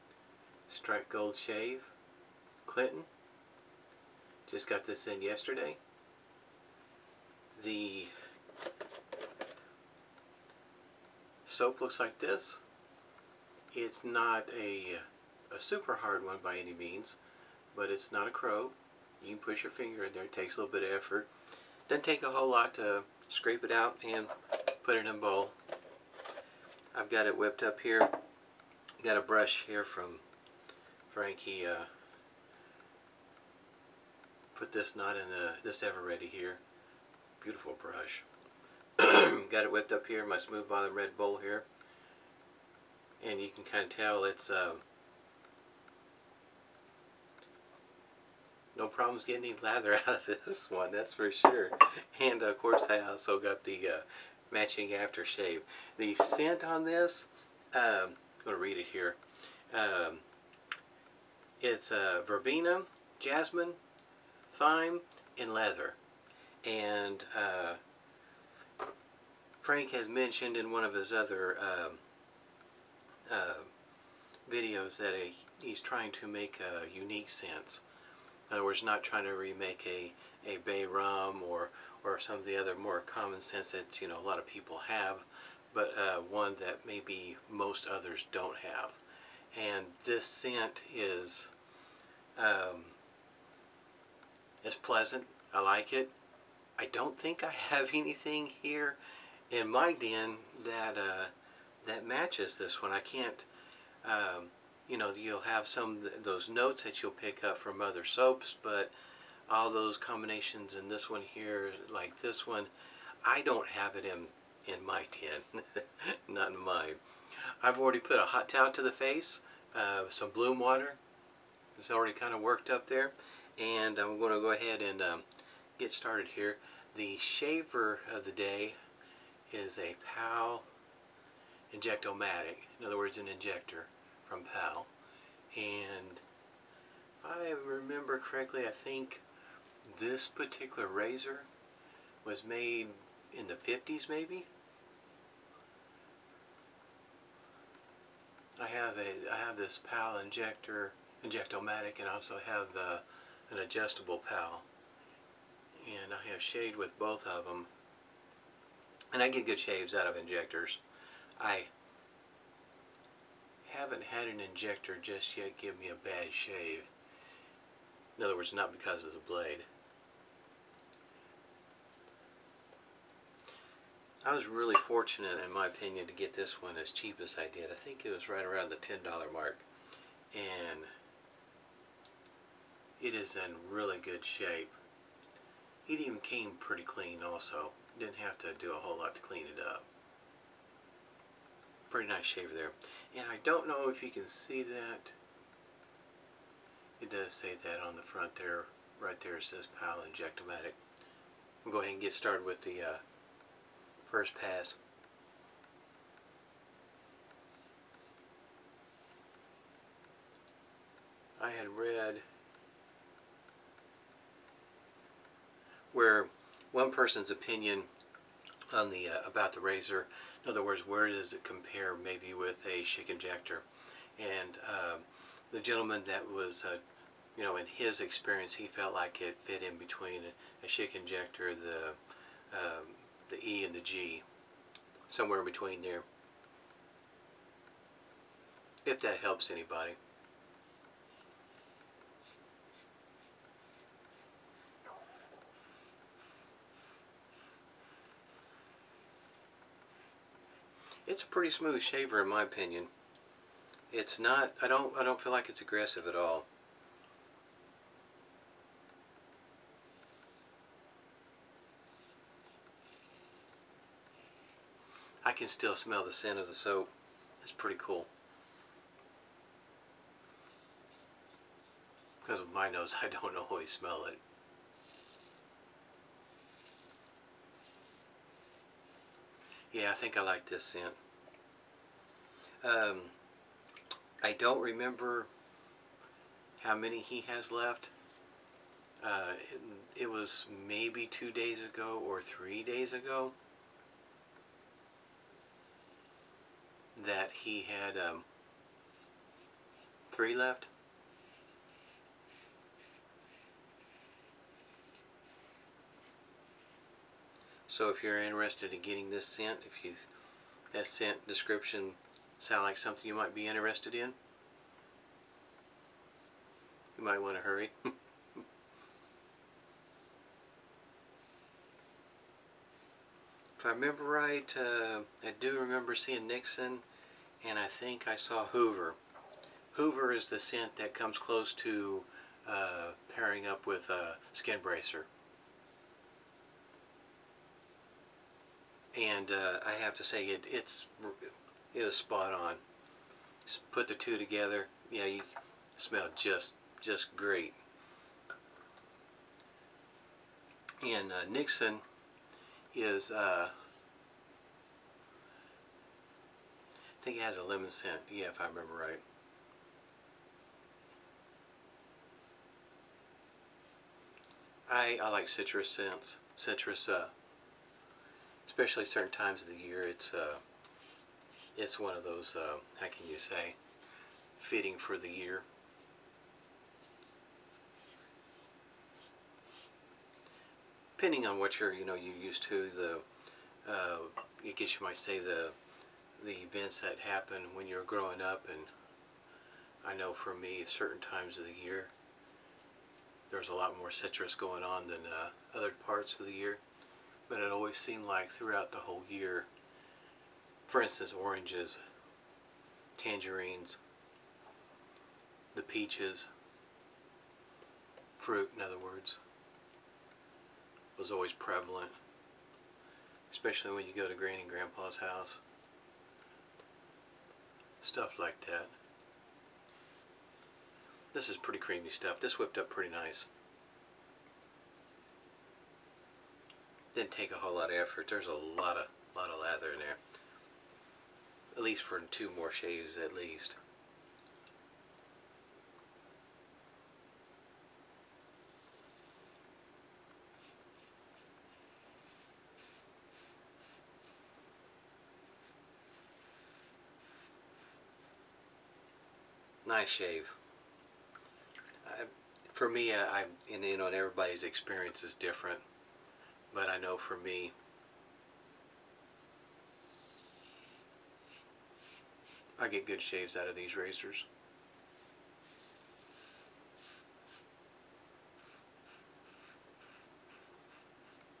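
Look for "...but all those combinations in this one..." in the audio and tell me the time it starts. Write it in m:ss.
1:48.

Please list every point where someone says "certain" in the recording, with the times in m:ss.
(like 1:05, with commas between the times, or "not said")
6:08, 6:30.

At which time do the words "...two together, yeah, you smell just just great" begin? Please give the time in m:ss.
5:43.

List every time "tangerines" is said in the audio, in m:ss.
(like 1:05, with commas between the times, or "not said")
6:42.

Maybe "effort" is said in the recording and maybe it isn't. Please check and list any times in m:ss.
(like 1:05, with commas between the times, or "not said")
0:20, 7:07.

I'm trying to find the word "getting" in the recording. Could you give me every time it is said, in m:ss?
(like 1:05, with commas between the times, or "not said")
0:49, 5:08.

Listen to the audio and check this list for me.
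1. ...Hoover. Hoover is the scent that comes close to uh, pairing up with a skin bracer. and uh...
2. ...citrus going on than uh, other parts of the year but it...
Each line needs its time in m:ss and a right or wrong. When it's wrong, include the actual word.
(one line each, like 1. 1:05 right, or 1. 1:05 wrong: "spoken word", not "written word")
1. 5:28 right
2. 6:33 right.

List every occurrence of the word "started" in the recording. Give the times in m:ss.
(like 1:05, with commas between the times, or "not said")
2:05, 3:22.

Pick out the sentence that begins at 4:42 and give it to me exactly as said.
Um, I don't remember how many he has left.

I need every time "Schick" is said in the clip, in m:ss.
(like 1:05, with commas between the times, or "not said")
3:42, 3:50.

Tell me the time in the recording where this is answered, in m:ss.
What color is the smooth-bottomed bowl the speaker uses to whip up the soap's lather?
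0:40.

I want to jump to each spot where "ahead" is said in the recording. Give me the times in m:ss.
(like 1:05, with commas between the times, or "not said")
2:04, 3:21.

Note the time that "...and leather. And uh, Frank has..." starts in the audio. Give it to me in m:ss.
1:05.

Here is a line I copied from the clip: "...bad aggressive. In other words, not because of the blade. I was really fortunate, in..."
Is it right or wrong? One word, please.
wrong.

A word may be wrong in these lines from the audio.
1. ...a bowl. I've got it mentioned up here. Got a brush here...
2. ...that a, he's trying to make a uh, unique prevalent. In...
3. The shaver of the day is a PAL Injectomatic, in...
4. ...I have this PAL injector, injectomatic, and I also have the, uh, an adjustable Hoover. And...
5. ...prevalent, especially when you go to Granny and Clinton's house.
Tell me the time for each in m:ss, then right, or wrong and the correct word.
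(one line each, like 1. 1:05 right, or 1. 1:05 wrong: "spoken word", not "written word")
1. 0:25 wrong: "whipped", not "mentioned"
2. 1:14 wrong: "scent", not "prevalent"
3. 2:06 right
4. 2:29 wrong: "PAL", not "Hoover"
5. 6:51 wrong: "Grandpa", not "Clinton".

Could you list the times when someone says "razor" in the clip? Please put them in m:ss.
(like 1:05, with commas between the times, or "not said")
2:20, 3:39, 7:43.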